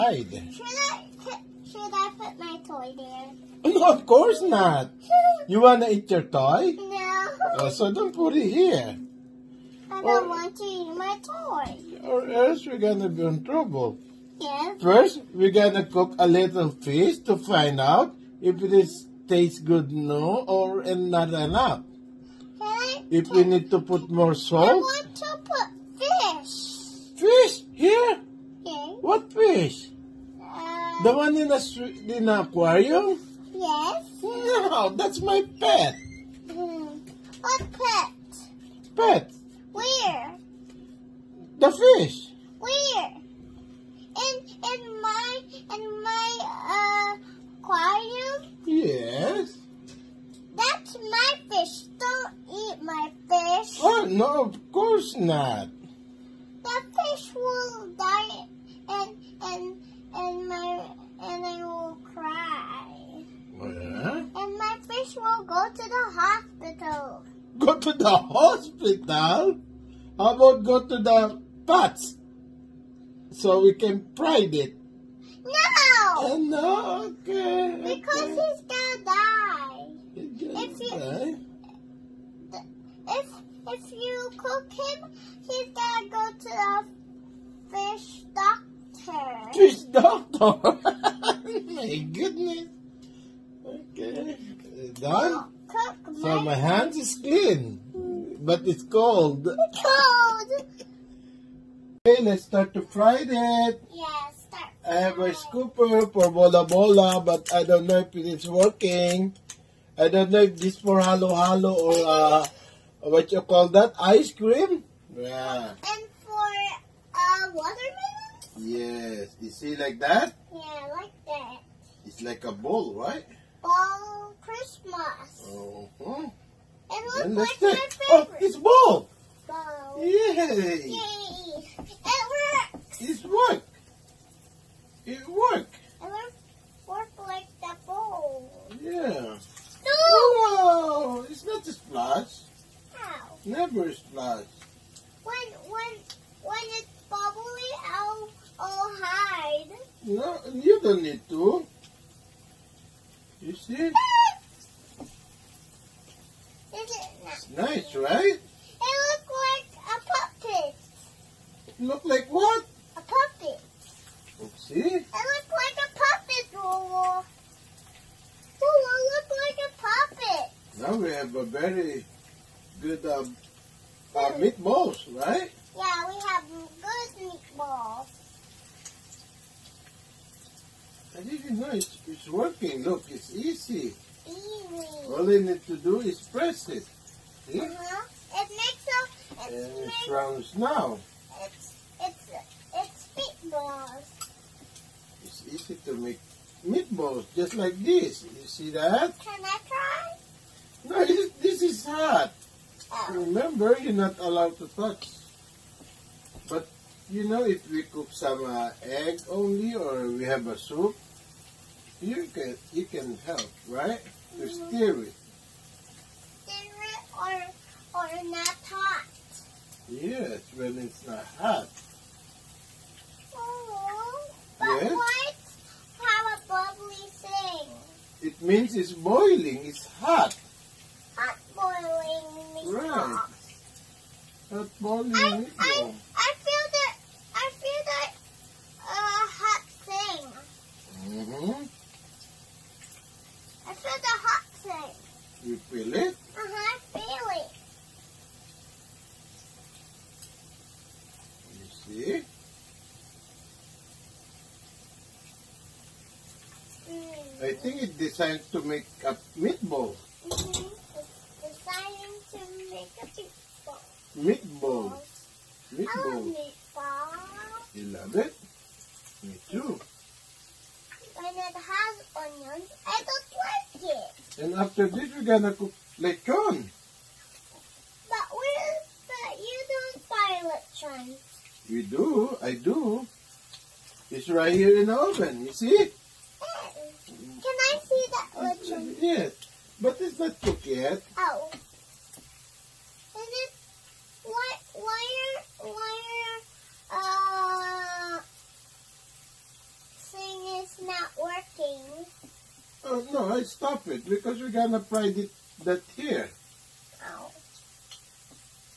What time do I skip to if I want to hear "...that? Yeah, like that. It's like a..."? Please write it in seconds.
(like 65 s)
119 s.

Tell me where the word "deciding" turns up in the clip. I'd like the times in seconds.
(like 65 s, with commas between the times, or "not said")
261 s.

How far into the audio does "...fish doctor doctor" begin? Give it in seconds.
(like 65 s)
87 s.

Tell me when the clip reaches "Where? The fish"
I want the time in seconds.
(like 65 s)
39 s.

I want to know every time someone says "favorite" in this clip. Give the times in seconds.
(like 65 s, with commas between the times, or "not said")
127 s.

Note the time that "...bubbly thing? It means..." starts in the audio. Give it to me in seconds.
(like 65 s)
226 s.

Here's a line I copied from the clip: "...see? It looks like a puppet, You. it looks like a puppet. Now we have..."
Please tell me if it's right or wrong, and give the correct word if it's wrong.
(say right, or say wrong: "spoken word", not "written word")
wrong: "Rolo", not "You".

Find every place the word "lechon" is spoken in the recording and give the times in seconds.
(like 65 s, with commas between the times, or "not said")
275 s, 280 s, 288 s.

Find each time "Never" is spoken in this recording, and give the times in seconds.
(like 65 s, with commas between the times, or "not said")
143 s.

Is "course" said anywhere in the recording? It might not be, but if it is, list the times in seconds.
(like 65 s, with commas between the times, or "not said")
4 s, 54 s.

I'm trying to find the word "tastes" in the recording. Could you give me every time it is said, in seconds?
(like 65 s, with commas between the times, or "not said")
19 s.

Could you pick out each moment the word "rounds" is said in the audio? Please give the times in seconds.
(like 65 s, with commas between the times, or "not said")
190 s.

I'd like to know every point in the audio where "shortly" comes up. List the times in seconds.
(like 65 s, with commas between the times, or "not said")
not said.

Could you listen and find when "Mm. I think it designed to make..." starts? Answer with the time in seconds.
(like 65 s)
256 s.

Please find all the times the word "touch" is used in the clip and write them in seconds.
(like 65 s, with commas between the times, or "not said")
204 s.